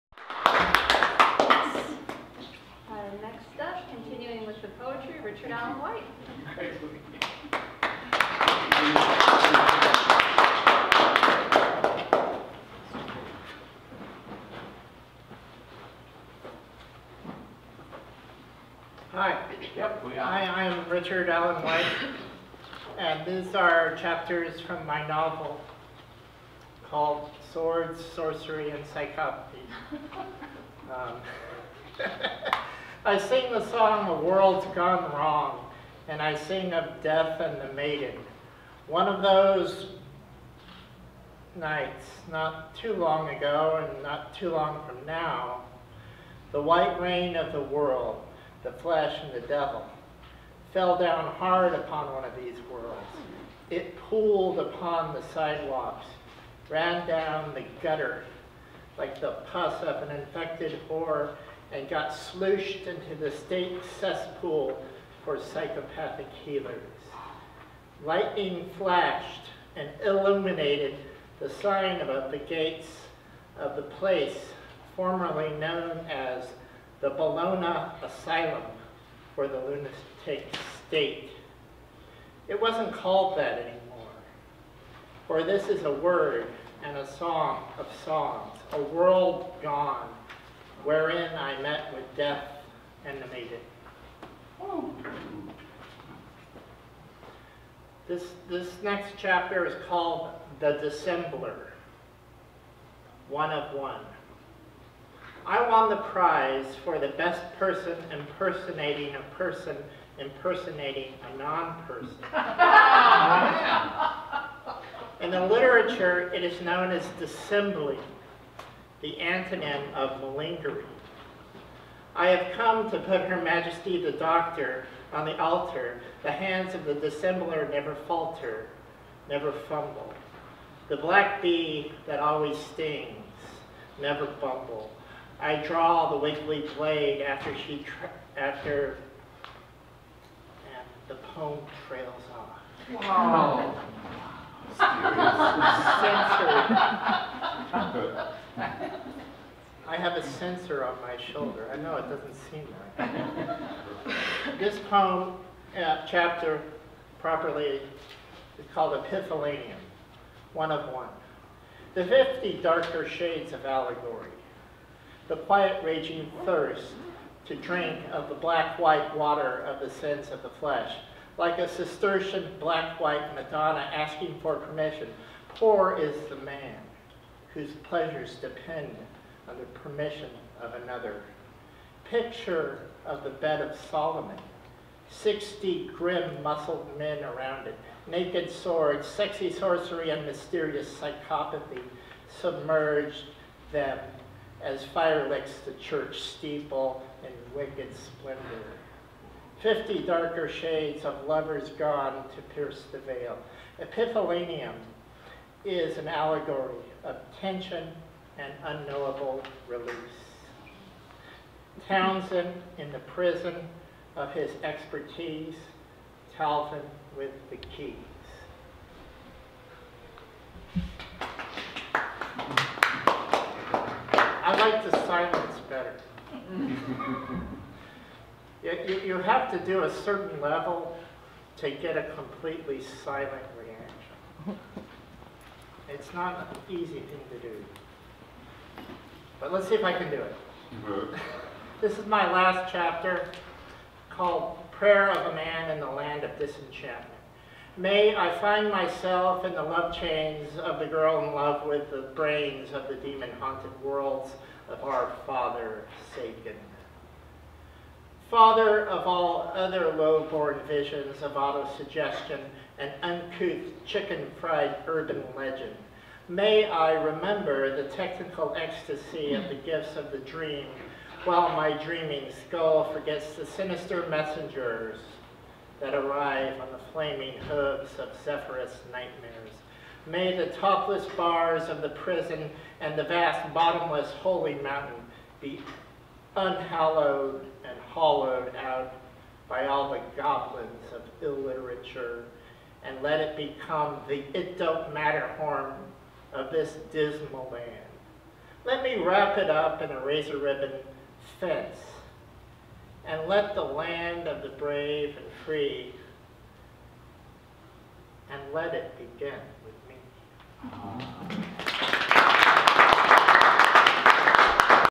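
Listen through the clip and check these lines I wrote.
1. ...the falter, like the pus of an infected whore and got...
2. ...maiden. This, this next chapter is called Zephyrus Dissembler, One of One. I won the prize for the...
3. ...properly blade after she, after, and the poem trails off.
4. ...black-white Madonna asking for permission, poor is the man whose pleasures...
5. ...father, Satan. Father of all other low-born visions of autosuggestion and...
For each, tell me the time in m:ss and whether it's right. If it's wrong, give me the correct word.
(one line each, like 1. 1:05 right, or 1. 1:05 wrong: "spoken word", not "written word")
1. 0:57 wrong: "gutter", not "falter"
2. 1:33 wrong: "The", not "Zephyrus"
3. 2:16 wrong: "wiggly", not "properly"
4. 2:52 right
5. 4:15 right.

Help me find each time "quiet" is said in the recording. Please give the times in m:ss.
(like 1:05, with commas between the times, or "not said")
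2:45.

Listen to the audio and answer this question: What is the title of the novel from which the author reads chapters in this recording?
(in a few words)
Swords, Sorcery, and Psychopathy.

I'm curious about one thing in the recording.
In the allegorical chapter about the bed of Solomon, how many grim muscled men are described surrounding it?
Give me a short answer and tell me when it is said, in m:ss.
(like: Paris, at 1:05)
60, at 3:05.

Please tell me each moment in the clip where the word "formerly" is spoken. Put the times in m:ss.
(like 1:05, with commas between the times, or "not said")
1:14.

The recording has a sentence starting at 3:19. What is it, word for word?
Fifty darker shades of lovers gone to pierce the veil.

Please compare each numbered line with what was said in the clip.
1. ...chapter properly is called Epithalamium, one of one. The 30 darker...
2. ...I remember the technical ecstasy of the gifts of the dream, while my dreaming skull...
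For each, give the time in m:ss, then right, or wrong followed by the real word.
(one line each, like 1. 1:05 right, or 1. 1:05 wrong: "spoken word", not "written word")
1. 2:36 wrong: "50", not "30"
2. 4:26 right.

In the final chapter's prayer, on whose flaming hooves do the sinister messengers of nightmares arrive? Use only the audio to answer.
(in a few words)
Zephyrus.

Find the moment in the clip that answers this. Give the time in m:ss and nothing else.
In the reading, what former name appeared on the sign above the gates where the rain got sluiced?
1:17.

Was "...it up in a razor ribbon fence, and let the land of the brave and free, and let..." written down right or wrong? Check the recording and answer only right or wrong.
right.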